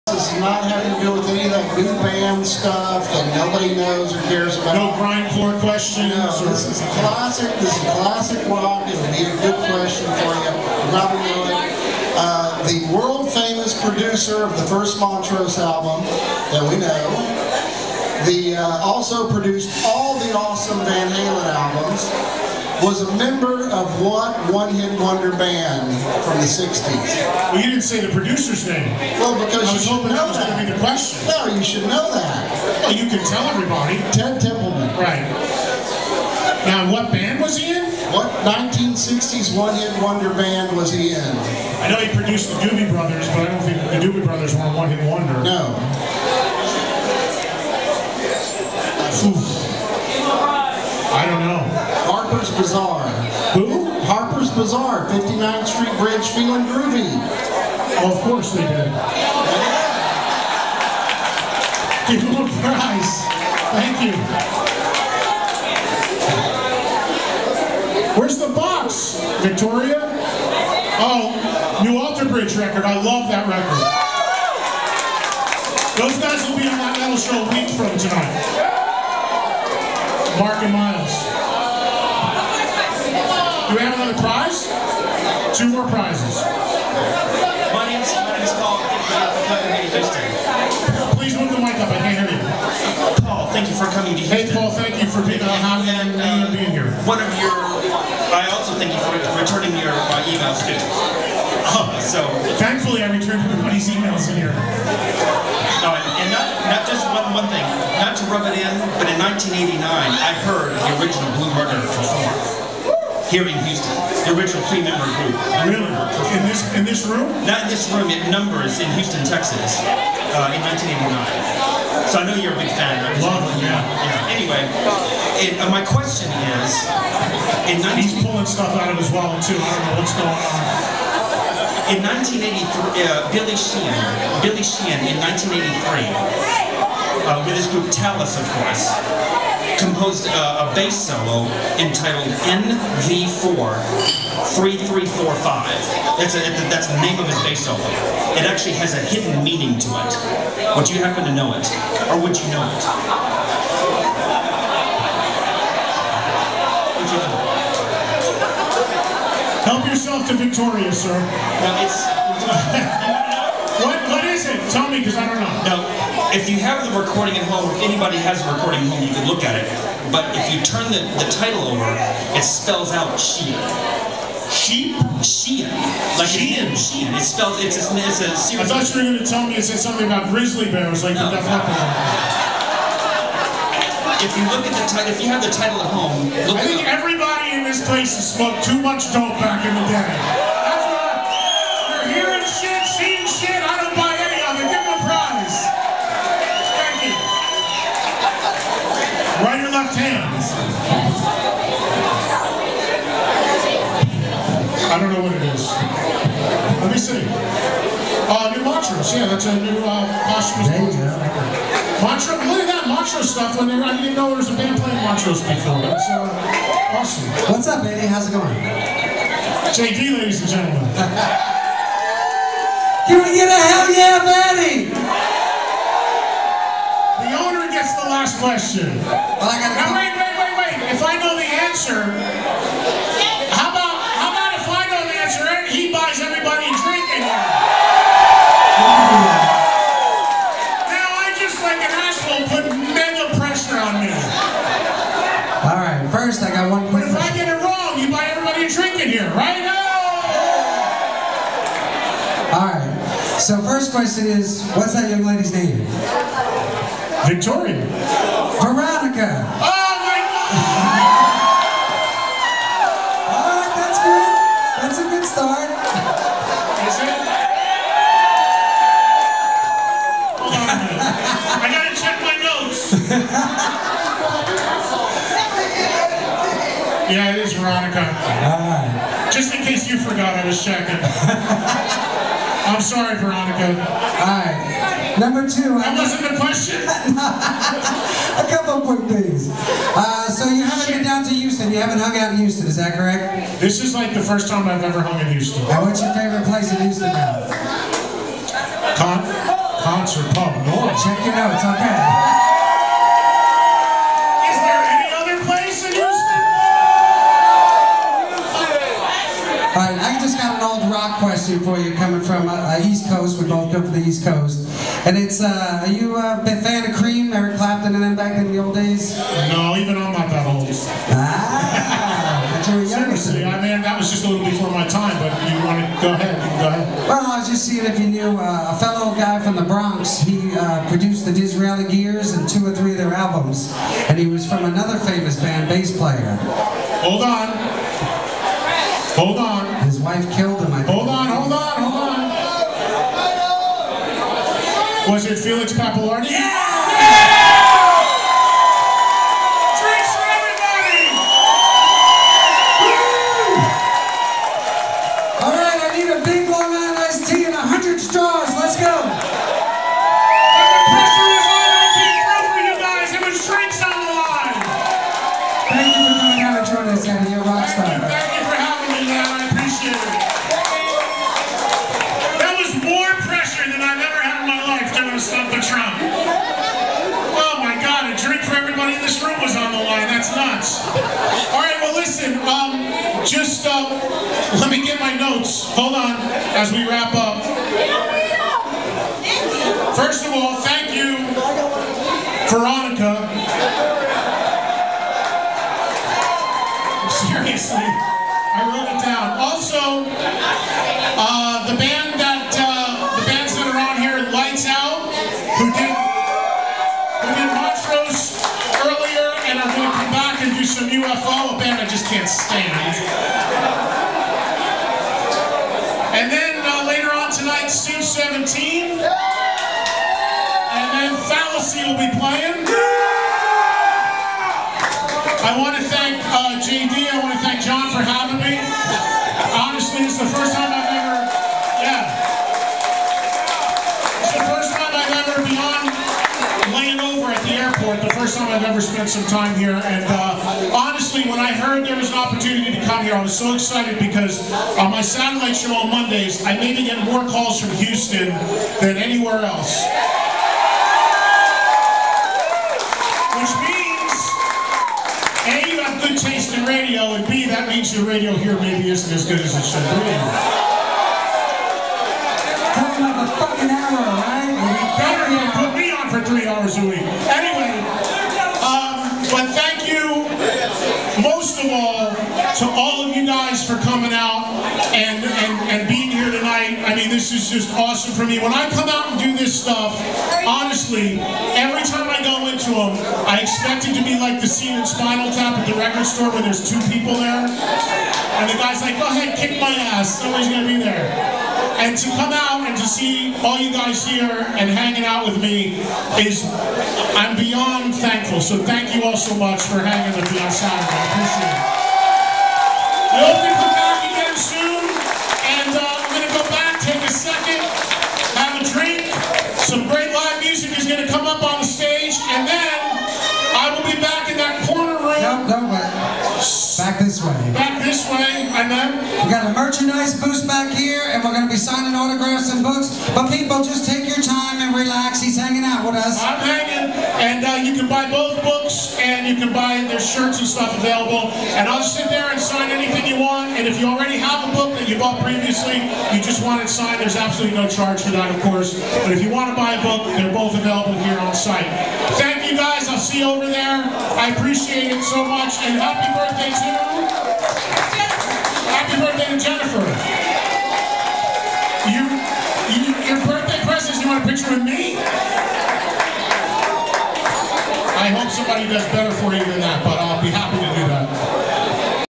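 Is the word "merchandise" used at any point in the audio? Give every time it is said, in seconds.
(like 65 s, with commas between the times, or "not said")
519 s.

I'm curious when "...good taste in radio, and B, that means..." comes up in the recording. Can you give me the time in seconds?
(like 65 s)
456 s.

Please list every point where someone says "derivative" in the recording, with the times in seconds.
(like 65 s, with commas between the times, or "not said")
not said.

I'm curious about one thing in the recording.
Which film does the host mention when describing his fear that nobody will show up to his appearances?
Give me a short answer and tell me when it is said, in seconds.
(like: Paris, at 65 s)
Spinal Tap, at 484 s.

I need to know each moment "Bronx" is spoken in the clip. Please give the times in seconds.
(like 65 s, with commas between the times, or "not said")
329 s.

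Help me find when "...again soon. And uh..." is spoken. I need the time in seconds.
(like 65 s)
504 s.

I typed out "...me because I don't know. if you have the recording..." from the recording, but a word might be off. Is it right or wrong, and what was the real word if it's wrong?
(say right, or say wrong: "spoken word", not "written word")
right.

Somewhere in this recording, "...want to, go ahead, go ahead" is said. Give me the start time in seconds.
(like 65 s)
325 s.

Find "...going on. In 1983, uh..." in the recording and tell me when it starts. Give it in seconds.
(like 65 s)
130 s.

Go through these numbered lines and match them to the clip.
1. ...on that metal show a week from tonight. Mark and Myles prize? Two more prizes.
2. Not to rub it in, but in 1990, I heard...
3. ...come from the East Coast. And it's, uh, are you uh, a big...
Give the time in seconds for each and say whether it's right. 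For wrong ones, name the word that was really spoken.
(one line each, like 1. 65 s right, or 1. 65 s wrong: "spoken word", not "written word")
1. 76 s right
2. 108 s wrong: "1989", not "1990"
3. 313 s right.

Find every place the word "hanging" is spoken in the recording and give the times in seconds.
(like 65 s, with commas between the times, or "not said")
494 s, 499 s.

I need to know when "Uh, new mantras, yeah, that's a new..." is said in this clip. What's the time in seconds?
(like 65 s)
208 s.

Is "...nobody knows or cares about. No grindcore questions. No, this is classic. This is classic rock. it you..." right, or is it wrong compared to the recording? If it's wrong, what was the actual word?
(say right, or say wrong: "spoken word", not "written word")
right.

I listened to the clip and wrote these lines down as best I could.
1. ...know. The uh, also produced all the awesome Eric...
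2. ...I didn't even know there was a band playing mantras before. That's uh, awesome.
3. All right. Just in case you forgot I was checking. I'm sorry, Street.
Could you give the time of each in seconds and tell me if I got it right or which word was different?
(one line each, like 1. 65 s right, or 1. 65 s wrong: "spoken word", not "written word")
1. 16 s wrong: "Van", not "Eric"
2. 213 s right
3. 278 s wrong: "Veronica", not "Street".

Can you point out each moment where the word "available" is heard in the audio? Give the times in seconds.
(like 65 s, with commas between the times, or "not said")
530 s, 540 s.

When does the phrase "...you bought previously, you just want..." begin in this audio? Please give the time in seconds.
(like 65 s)
534 s.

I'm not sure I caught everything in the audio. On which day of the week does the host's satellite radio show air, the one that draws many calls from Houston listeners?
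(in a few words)
Mondays.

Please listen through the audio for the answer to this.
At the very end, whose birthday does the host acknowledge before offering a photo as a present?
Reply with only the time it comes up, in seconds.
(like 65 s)
549 s.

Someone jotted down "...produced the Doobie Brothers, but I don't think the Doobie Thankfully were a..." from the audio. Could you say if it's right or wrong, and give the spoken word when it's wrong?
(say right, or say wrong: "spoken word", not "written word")
wrong: "Brothers", not "Thankfully".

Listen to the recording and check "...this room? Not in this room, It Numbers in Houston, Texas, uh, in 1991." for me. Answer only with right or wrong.
wrong.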